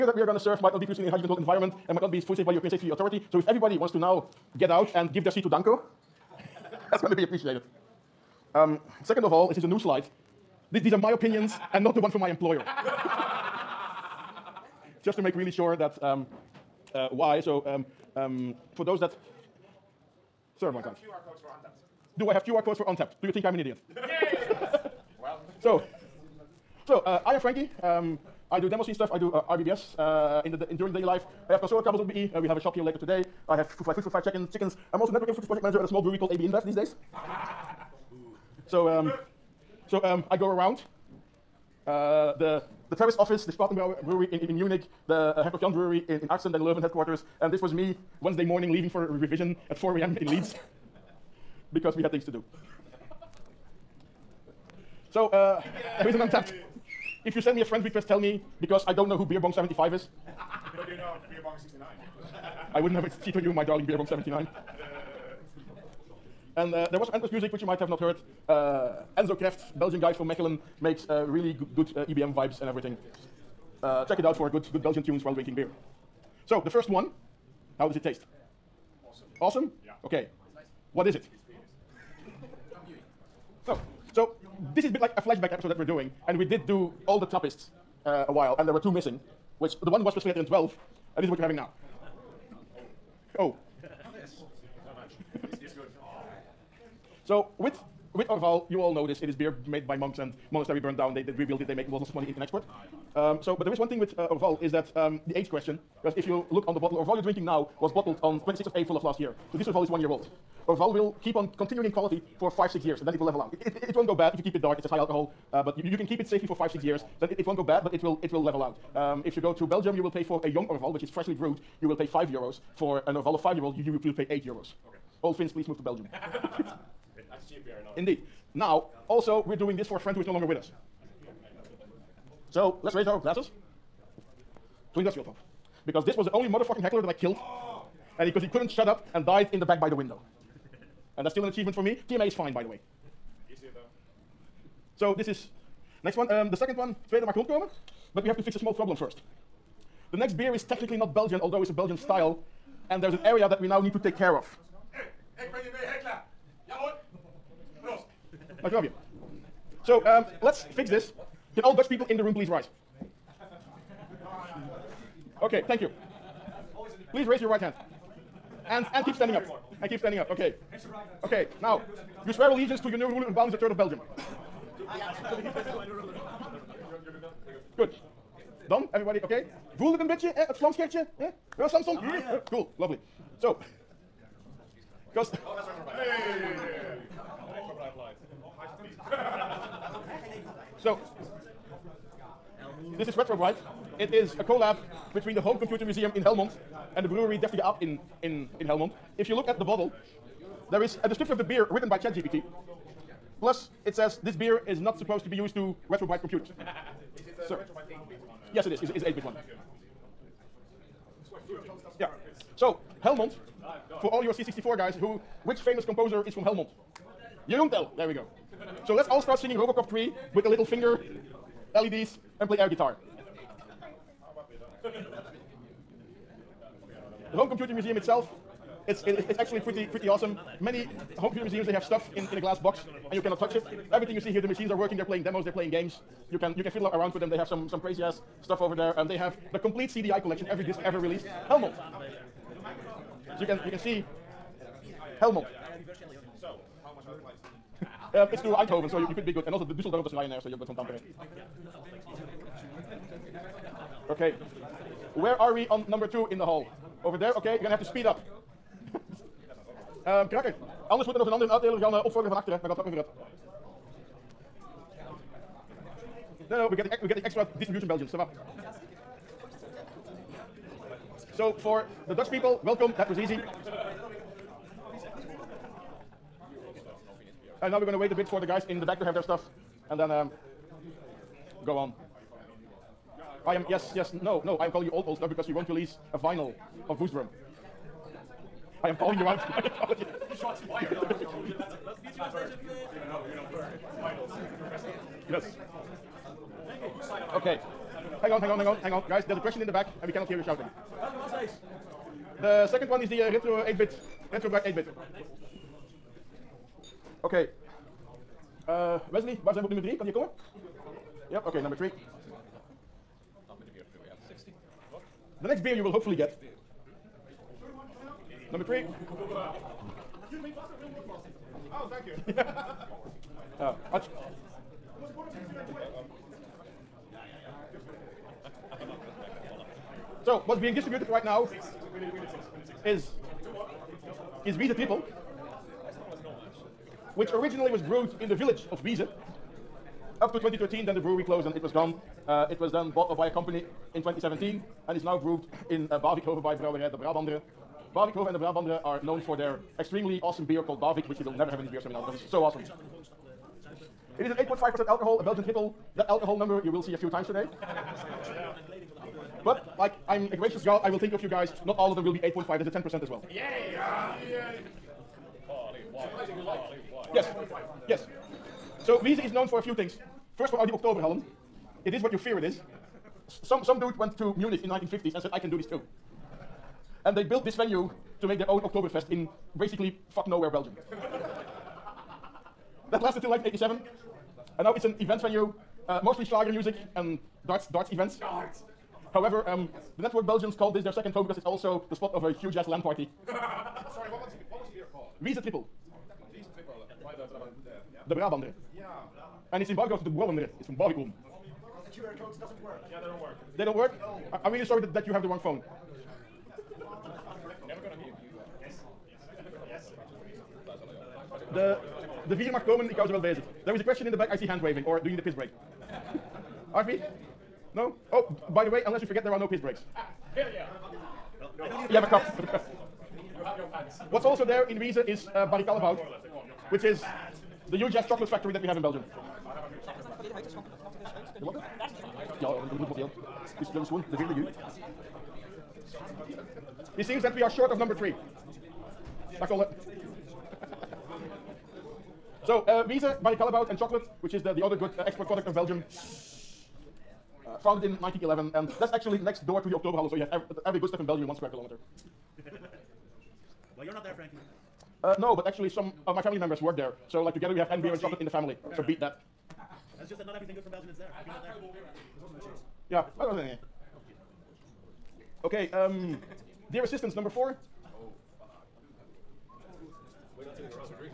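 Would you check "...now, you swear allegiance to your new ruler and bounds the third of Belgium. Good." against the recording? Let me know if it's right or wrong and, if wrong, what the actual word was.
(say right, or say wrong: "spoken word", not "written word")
right.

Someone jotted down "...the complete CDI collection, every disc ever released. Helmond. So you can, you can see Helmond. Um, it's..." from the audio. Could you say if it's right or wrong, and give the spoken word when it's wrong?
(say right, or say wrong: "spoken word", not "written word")
right.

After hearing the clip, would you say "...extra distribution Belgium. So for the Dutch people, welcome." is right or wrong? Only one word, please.
right.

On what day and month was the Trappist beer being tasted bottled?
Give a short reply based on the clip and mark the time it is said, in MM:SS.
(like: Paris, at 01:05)
26 April, at 01:48.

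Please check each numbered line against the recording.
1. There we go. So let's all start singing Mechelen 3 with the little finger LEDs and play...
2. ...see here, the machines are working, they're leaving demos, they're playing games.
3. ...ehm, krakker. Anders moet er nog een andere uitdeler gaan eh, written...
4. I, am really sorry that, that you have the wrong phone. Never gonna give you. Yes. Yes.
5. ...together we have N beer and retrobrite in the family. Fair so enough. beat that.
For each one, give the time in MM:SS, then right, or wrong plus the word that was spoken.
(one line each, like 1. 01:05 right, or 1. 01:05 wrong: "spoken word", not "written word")
1. 03:37 wrong: "Robocop", not "Mechelen"
2. 03:54 wrong: "playing", not "leaving"
3. 04:20 wrong: "opvorderen", not "written"
4. 06:44 right
5. 07:37 wrong: "chocolate", not "retrobrite".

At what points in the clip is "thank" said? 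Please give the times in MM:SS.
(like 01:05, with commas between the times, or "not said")
02:45, 05:21.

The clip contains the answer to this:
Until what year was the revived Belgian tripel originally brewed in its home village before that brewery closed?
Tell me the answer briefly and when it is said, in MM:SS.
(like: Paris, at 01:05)
2013, at 05:40.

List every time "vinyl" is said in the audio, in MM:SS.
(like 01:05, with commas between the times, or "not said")
04:46.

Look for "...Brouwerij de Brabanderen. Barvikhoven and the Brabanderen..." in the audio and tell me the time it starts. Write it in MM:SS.
05:46.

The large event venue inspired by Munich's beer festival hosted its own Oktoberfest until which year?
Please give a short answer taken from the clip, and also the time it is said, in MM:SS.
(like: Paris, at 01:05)
1987, at 06:23.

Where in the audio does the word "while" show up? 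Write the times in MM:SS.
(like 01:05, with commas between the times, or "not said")
01:15, 01:28.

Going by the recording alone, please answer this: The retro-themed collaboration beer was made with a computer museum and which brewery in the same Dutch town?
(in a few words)
Deftige Aap.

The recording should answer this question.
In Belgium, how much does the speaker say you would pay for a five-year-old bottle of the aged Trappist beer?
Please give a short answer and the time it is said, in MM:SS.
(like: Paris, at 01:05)
8 euros, at 02:04.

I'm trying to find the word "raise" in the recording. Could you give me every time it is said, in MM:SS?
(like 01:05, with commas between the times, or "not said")
02:12, 02:47.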